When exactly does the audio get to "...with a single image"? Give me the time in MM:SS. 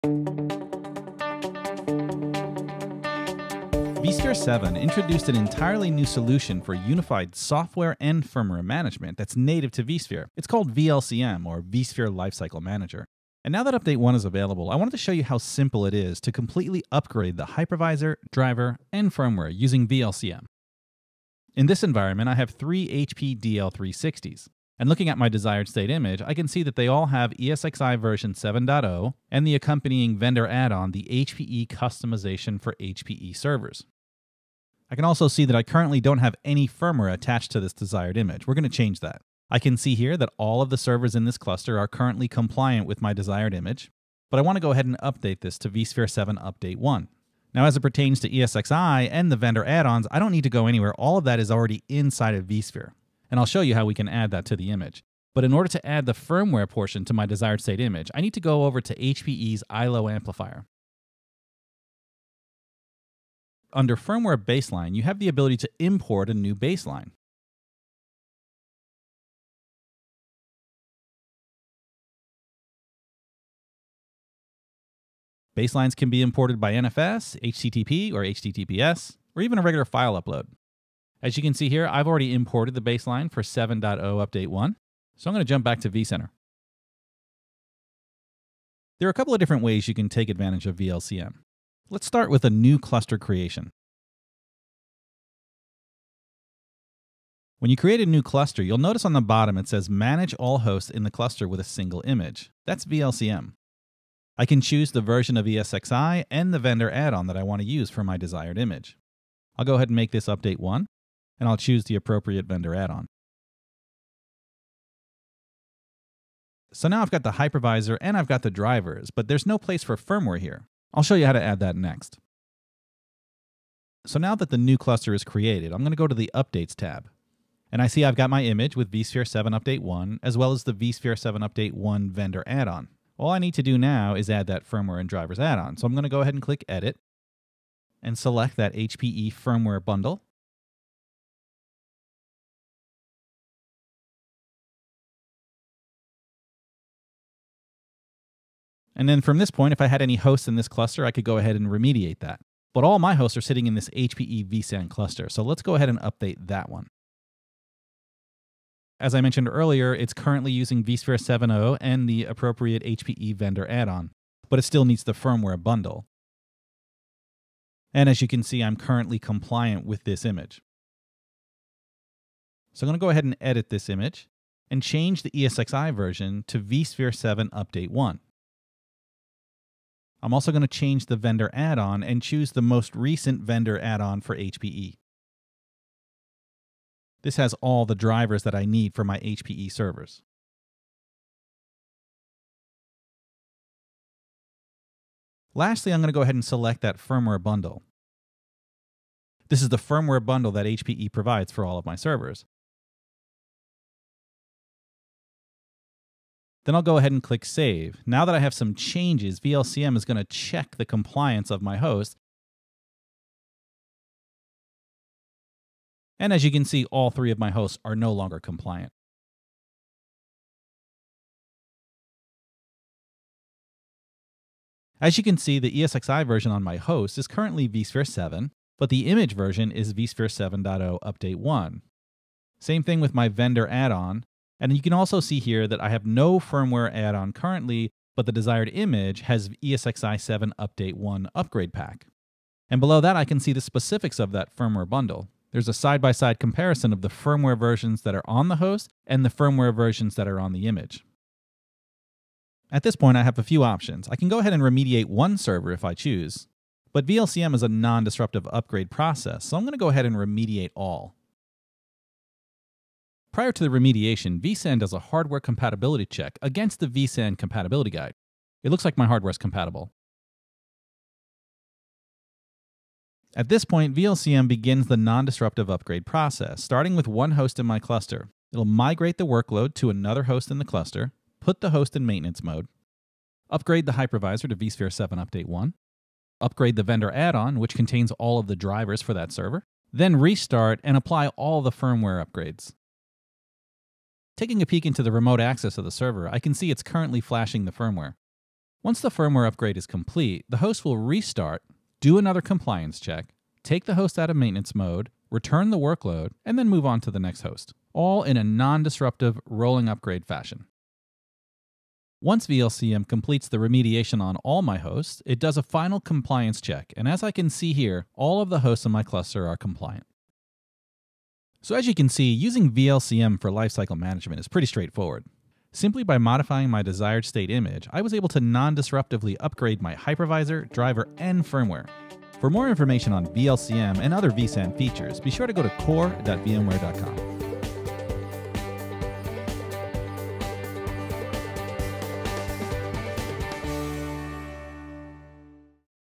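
01:41.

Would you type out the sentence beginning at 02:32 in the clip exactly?
But all my hosts are sitting in this HPE vSAN cluster.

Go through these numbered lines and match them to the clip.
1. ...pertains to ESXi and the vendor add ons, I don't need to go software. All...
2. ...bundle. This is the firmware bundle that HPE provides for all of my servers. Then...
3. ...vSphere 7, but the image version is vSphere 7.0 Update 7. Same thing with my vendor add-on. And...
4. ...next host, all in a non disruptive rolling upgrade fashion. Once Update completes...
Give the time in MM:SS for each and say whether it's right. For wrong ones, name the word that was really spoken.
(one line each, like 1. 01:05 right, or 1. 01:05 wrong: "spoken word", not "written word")
1. 00:47 wrong: "anywhere", not "software"
2. 03:17 right
3. 03:47 wrong: "1", not "7"
4. 05:07 wrong: "VLCM", not "Update".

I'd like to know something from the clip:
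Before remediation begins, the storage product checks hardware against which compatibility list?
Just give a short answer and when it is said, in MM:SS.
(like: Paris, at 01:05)
vSAN compatibility guide, at 04:26.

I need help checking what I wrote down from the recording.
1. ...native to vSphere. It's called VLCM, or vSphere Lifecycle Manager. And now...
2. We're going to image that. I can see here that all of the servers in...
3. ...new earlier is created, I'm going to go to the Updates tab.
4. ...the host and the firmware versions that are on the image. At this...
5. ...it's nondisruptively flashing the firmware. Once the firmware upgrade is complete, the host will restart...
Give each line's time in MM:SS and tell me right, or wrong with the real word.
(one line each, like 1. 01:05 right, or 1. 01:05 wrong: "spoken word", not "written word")
1. 00:09 right
2. 00:38 wrong: "change", not "image"
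3. 02:04 wrong: "cluster", not "earlier"
4. 04:08 right
5. 04:56 wrong: "currently", not "nondisruptively".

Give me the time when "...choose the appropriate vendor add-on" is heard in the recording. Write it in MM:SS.
01:51.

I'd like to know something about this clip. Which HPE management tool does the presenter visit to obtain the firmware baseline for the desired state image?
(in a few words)
iLO Amplifier.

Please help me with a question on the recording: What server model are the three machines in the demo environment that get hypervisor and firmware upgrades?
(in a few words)
HP DL360.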